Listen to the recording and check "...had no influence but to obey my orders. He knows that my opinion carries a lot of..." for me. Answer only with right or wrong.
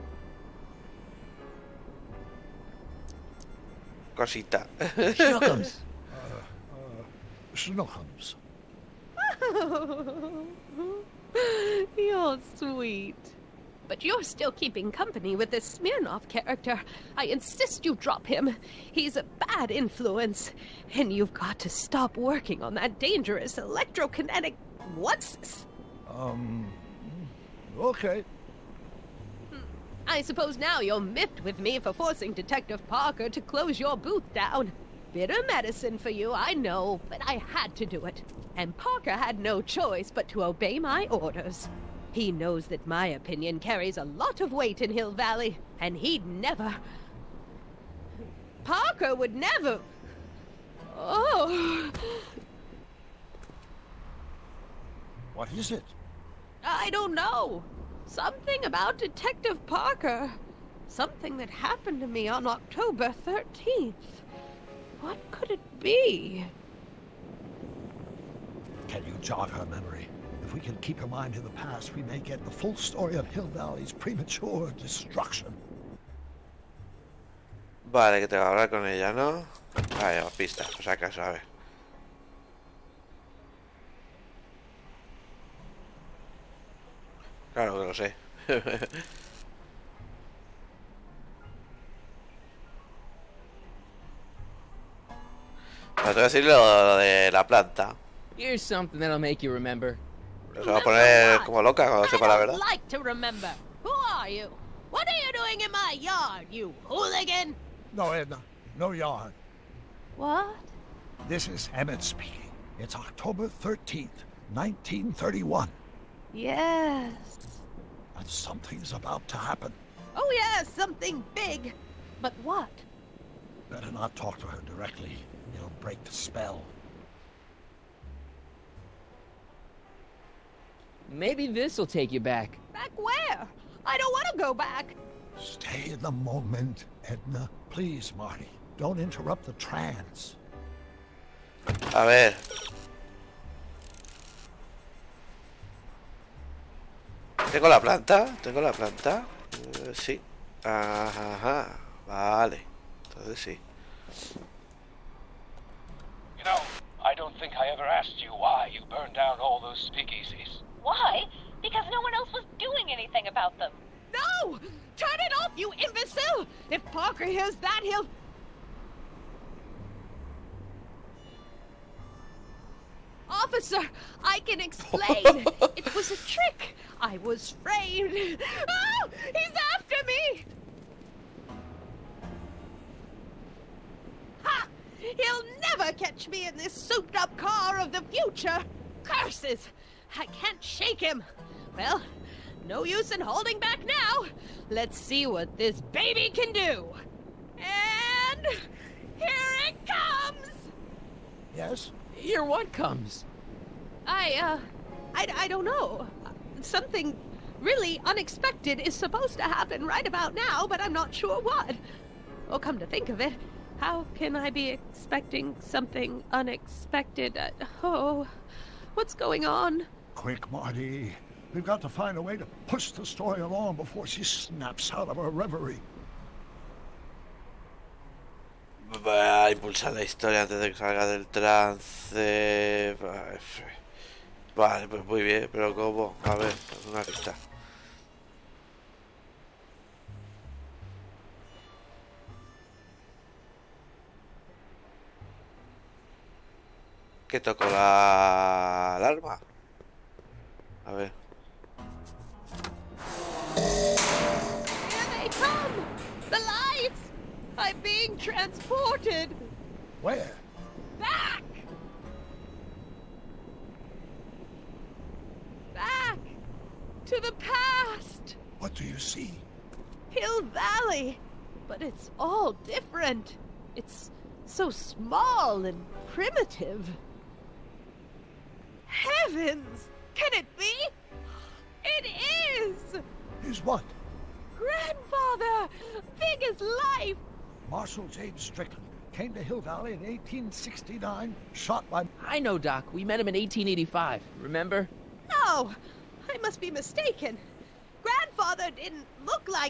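wrong.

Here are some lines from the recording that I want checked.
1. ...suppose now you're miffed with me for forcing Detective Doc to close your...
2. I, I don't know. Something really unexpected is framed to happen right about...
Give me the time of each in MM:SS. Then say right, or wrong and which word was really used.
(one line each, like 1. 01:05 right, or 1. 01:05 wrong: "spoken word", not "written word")
1. 00:30 wrong: "Parker", not "Doc"
2. 03:25 wrong: "supposed", not "framed".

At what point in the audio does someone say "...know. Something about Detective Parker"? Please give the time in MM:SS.
00:57.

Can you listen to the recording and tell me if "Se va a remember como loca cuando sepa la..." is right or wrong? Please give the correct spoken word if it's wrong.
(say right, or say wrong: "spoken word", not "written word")
wrong: "poner", not "remember".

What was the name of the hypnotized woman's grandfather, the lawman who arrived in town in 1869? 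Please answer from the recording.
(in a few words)
Marshal James Strickland.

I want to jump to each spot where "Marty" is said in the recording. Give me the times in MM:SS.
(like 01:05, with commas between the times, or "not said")
02:18, 03:40.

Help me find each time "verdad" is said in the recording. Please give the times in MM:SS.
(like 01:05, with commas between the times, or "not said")
01:42.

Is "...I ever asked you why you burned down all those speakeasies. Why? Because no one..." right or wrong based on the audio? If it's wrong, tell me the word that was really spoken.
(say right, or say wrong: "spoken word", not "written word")
right.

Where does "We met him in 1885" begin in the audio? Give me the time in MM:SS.
04:52.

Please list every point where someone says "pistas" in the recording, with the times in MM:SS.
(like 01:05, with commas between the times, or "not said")
01:20, 03:57.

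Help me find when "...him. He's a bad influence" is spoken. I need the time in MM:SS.
00:18.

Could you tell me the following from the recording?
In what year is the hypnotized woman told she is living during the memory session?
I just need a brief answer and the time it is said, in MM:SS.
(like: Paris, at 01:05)
1931, at 01:54.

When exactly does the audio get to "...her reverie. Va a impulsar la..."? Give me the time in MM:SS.
03:45.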